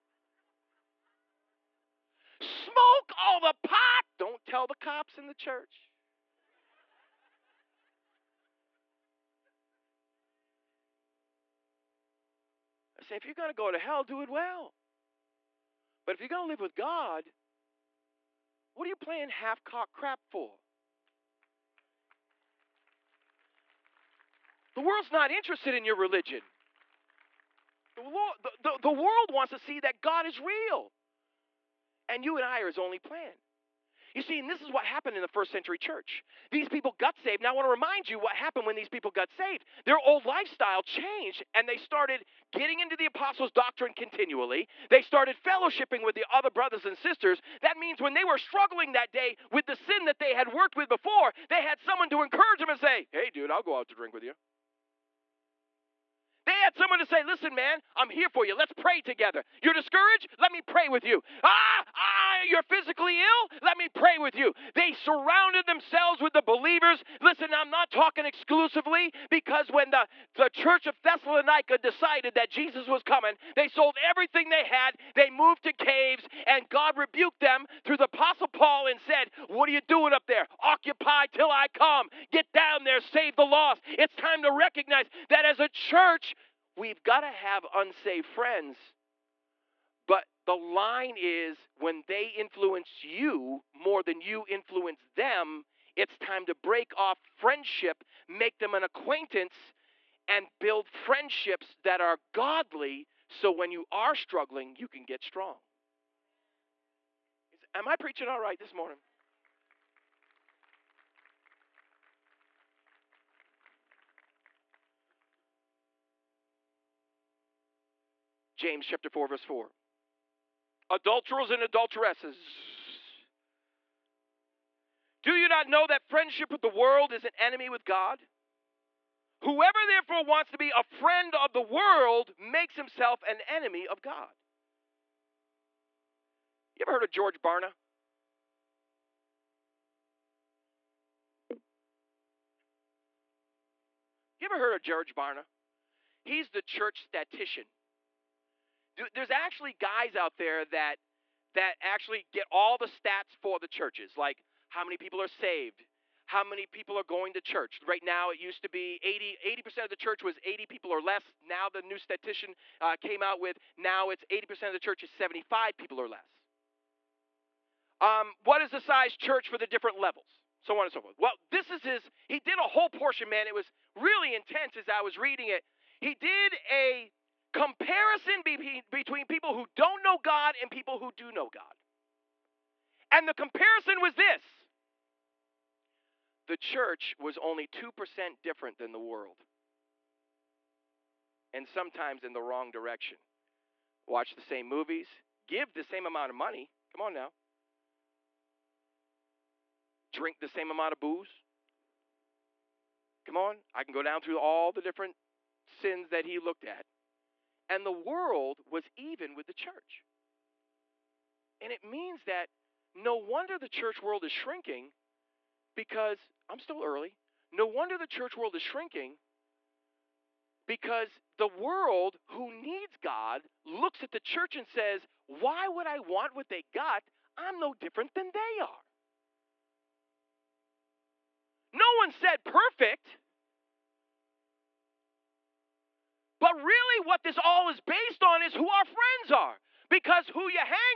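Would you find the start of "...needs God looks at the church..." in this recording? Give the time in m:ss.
3:42.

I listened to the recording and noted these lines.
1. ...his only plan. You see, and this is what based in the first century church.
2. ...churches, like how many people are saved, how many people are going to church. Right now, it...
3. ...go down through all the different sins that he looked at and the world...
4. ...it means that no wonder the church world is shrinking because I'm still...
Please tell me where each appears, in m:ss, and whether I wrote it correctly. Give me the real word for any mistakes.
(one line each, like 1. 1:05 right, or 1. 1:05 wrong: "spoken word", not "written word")
1. 0:32 wrong: "happened", not "based"
2. 2:33 right
3. 3:23 right
4. 3:31 right.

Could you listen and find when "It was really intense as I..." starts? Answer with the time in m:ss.
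2:53.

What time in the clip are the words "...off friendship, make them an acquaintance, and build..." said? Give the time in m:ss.
1:36.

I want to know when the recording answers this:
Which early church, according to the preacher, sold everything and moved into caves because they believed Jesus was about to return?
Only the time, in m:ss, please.
1:11.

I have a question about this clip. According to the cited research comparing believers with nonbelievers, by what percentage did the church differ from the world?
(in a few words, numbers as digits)
2%.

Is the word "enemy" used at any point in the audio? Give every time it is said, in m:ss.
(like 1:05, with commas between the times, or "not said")
2:07, 2:13.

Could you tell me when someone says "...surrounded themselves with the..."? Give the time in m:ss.
1:04.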